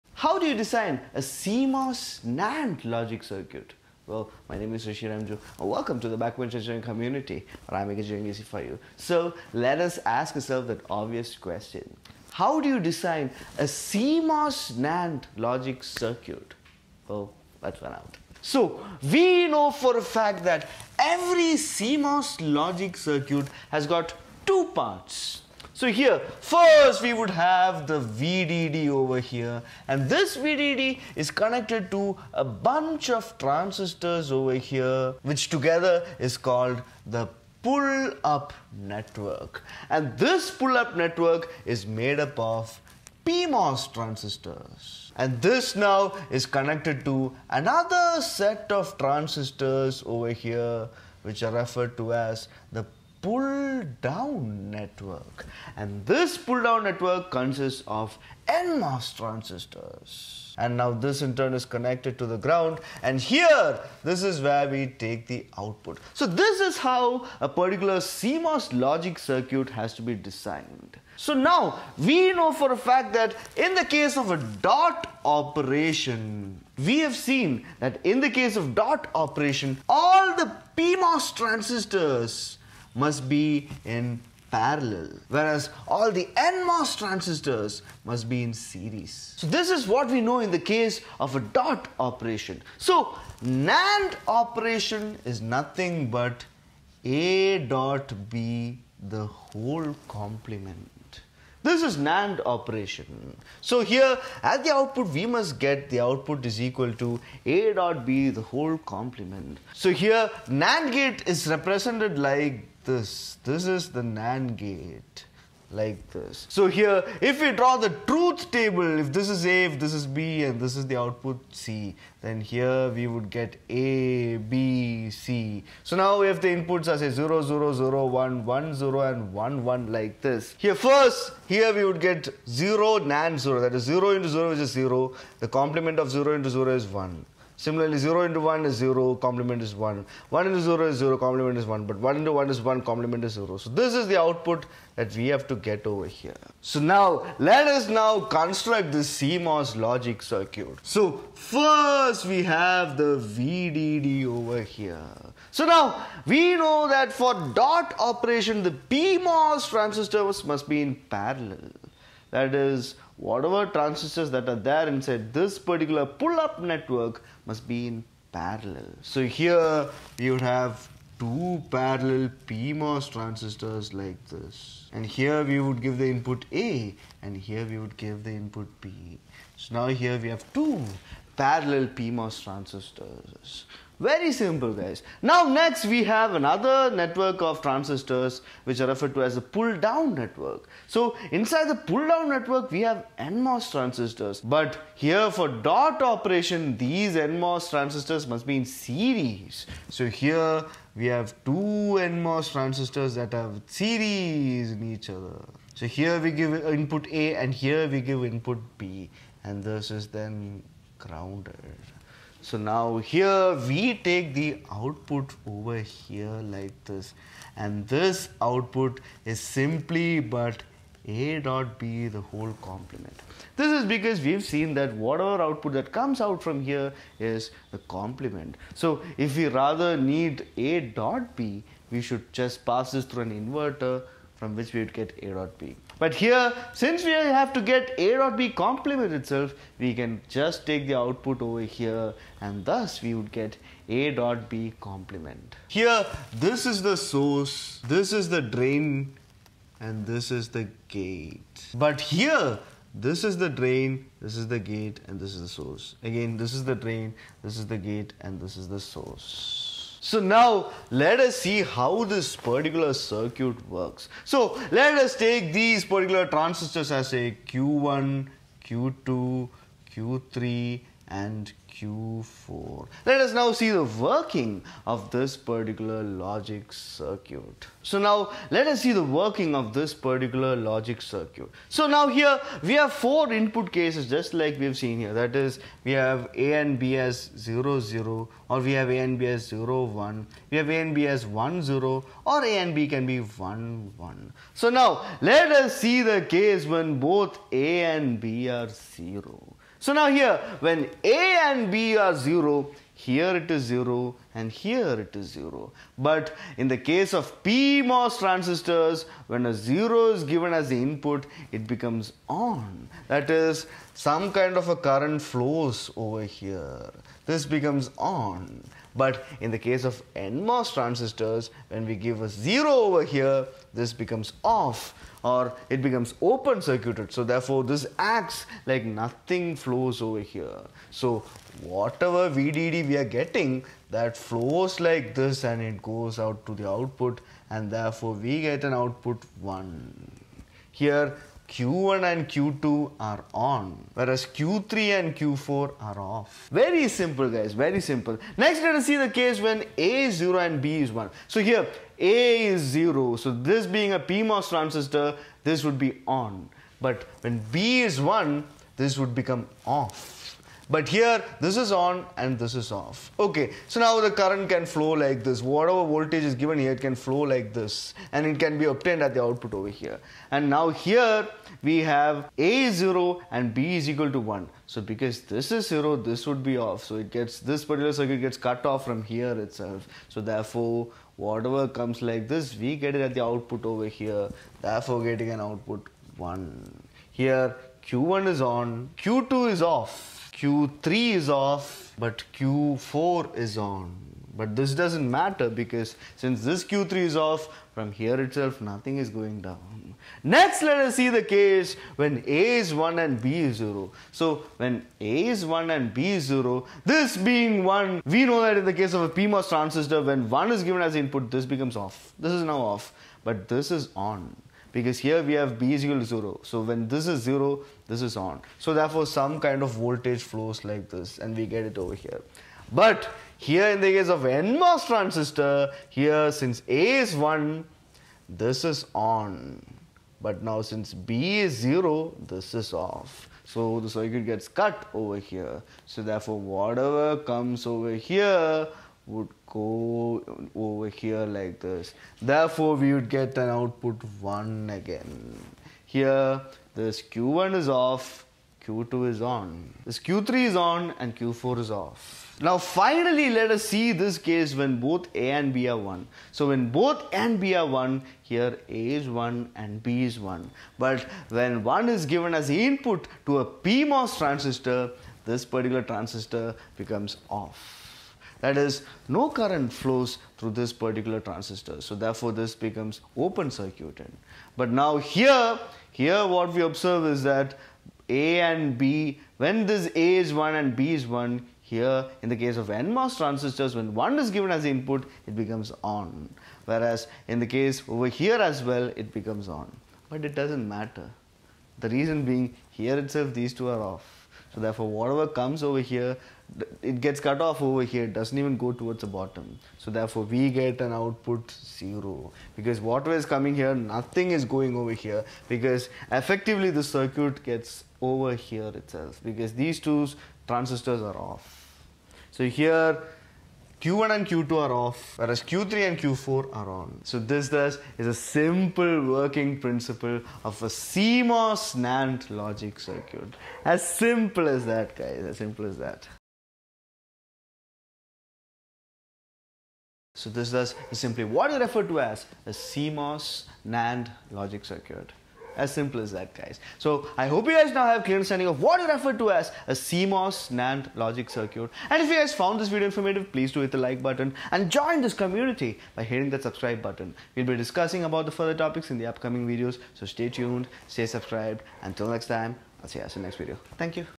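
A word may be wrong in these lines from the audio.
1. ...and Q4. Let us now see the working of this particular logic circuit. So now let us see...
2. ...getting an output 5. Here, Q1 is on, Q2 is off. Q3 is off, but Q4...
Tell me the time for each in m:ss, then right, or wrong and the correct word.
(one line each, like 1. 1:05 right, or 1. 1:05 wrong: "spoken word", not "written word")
1. 4:31 right
2. 6:25 wrong: "1", not "5".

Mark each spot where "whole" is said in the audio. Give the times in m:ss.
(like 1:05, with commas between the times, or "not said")
1:39, 1:48, 3:42.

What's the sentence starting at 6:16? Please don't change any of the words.
So it gets, this particular circuit gets cut off from here itself.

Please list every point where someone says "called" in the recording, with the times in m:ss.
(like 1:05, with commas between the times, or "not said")
0:36.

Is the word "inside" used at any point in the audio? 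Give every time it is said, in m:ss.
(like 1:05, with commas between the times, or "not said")
2:44, 3:11.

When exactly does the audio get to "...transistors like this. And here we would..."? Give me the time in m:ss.
2:53.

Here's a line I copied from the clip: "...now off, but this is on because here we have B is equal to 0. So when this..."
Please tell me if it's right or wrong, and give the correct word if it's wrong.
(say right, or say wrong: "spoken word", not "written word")
right.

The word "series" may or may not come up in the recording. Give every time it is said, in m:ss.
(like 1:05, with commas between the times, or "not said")
1:28, 3:18, 3:23.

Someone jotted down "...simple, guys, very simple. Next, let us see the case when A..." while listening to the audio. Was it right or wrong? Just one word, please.
right.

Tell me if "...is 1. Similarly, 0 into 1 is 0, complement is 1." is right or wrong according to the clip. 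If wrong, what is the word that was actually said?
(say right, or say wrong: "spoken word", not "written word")
right.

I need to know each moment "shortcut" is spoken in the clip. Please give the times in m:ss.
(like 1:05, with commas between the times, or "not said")
not said.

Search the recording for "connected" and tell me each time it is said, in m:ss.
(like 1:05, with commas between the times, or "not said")
0:31, 0:46, 1:01.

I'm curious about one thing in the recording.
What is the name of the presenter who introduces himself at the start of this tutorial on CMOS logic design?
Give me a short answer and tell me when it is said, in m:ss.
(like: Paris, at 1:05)
Rishi Remju, at 0:04.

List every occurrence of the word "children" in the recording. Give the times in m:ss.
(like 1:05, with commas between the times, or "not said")
not said.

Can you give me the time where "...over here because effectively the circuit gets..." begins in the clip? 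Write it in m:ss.
8:24.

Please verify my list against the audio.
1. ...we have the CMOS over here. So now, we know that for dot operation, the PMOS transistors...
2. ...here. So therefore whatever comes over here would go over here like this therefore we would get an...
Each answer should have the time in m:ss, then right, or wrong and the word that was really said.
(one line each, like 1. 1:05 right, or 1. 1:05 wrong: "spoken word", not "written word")
1. 2:32 wrong: "VDD", not "CMOS"
2. 7:15 right.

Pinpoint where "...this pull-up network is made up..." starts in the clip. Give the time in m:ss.
0:40.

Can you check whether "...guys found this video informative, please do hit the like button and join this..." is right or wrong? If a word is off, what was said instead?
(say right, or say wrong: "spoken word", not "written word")
right.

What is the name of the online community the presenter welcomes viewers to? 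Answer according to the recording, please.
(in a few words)
Backbench Engineering.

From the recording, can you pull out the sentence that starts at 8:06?
Whereas in the case over here as well, it becomes on.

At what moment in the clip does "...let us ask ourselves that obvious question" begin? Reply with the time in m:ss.
0:09.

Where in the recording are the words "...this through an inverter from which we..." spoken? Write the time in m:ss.
3:52.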